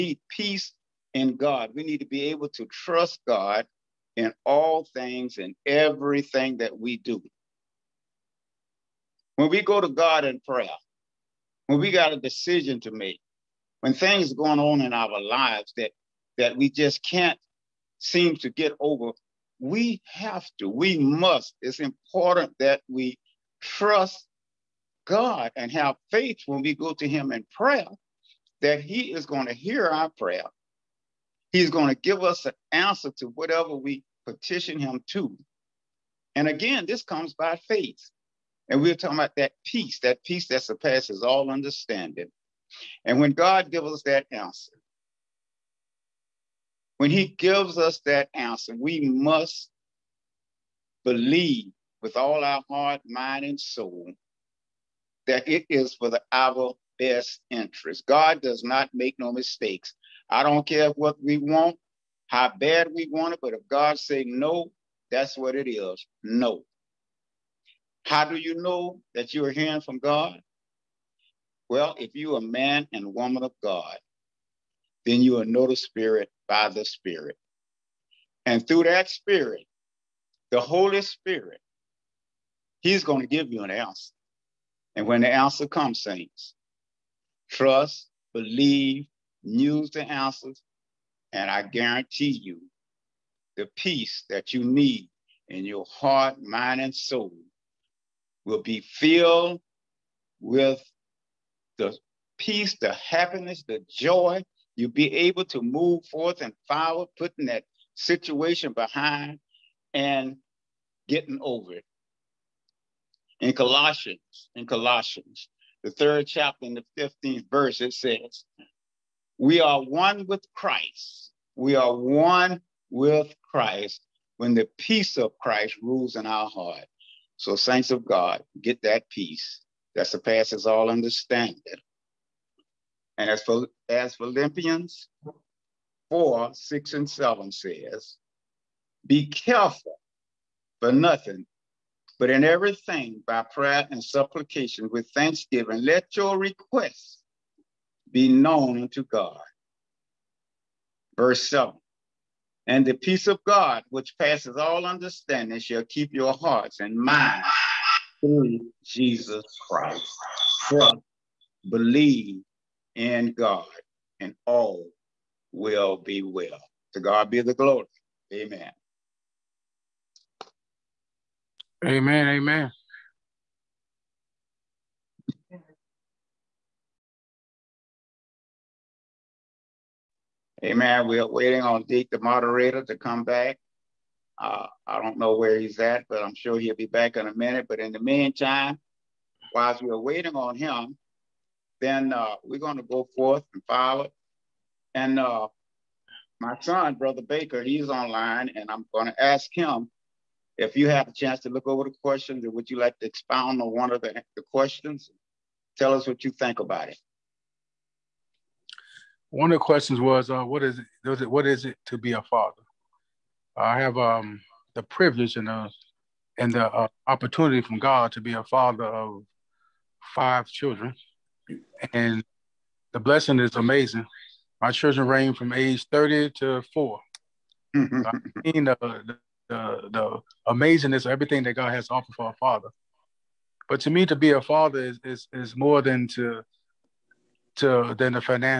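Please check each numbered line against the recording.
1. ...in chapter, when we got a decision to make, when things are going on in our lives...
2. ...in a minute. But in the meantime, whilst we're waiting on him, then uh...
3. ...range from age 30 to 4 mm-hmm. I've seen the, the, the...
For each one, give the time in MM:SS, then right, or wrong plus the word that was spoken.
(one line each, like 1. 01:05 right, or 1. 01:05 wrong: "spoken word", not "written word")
1. 00:10 wrong: "prayer", not "chapter"
2. 03:07 right
3. 03:45 right.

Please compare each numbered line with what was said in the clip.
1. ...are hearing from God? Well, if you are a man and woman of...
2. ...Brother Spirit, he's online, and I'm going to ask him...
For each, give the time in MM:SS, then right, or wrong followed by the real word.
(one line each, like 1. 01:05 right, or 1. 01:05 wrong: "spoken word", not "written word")
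1. 01:09 right
2. 03:16 wrong: "Baker", not "Spirit".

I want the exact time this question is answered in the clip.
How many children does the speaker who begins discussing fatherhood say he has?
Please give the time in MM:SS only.
03:40.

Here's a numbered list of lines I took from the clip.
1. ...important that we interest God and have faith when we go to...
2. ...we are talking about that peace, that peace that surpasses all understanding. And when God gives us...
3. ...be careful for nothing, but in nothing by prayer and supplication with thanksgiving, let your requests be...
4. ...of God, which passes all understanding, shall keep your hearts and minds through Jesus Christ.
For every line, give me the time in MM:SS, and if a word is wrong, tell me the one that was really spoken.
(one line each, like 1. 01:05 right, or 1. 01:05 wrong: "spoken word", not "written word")
1. 00:21 wrong: "trust", not "interest"
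2. 00:38 right
3. 02:19 wrong: "everything", not "nothing"
4. 02:33 right.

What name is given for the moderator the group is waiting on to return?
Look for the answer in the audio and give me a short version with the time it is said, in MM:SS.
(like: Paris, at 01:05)
Deke, at 03:01.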